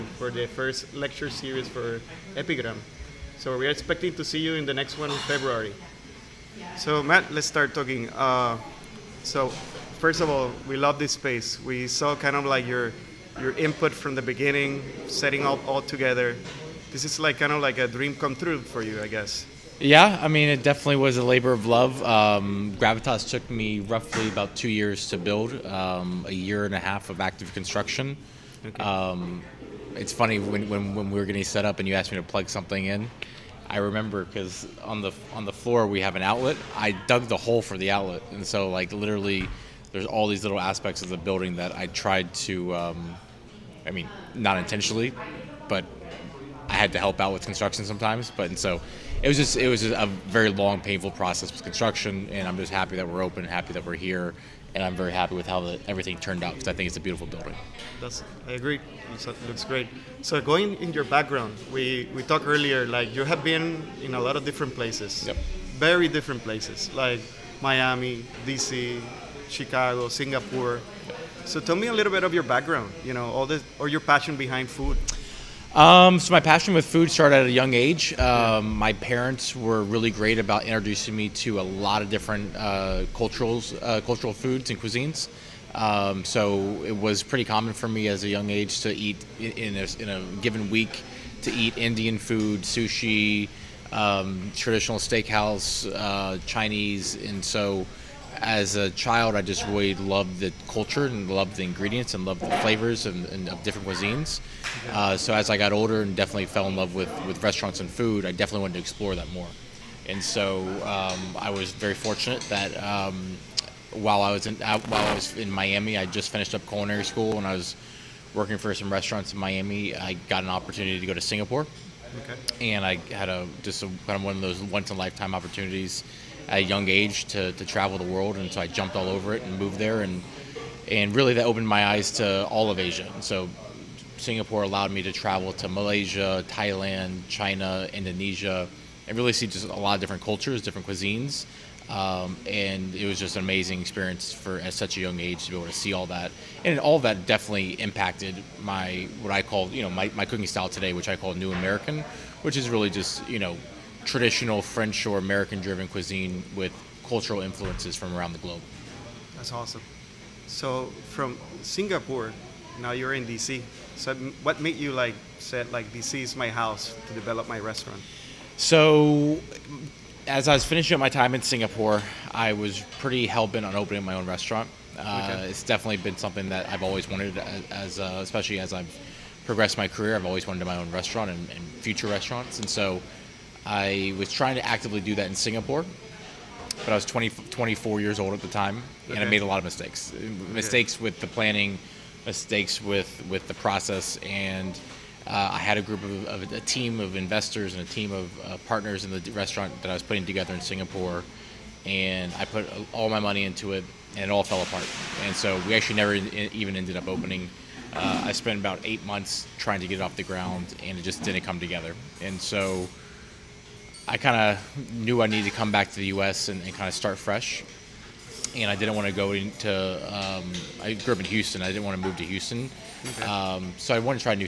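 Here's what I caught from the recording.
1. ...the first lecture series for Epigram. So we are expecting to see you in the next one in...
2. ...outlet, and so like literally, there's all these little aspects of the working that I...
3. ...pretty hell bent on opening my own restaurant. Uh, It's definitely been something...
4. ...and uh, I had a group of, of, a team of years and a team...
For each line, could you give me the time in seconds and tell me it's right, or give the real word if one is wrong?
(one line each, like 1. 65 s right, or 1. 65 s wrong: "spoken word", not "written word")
1. 0 s right
2. 37 s wrong: "building", not "working"
3. 172 s right
4. 194 s wrong: "investors", not "years".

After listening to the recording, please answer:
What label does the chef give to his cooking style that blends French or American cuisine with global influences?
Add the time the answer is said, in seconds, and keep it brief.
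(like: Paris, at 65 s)
New American, at 151 s.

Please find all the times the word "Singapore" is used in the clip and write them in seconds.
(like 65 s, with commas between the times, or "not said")
70 s, 121 s, 134 s, 161 s, 171 s, 185 s, 200 s.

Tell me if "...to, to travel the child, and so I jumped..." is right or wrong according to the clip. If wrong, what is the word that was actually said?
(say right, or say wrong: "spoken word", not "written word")
wrong: "world", not "child".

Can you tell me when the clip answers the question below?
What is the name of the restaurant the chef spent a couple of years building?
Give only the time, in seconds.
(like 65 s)
22 s.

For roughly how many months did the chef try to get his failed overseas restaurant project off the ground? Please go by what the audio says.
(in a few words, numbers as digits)
8 months.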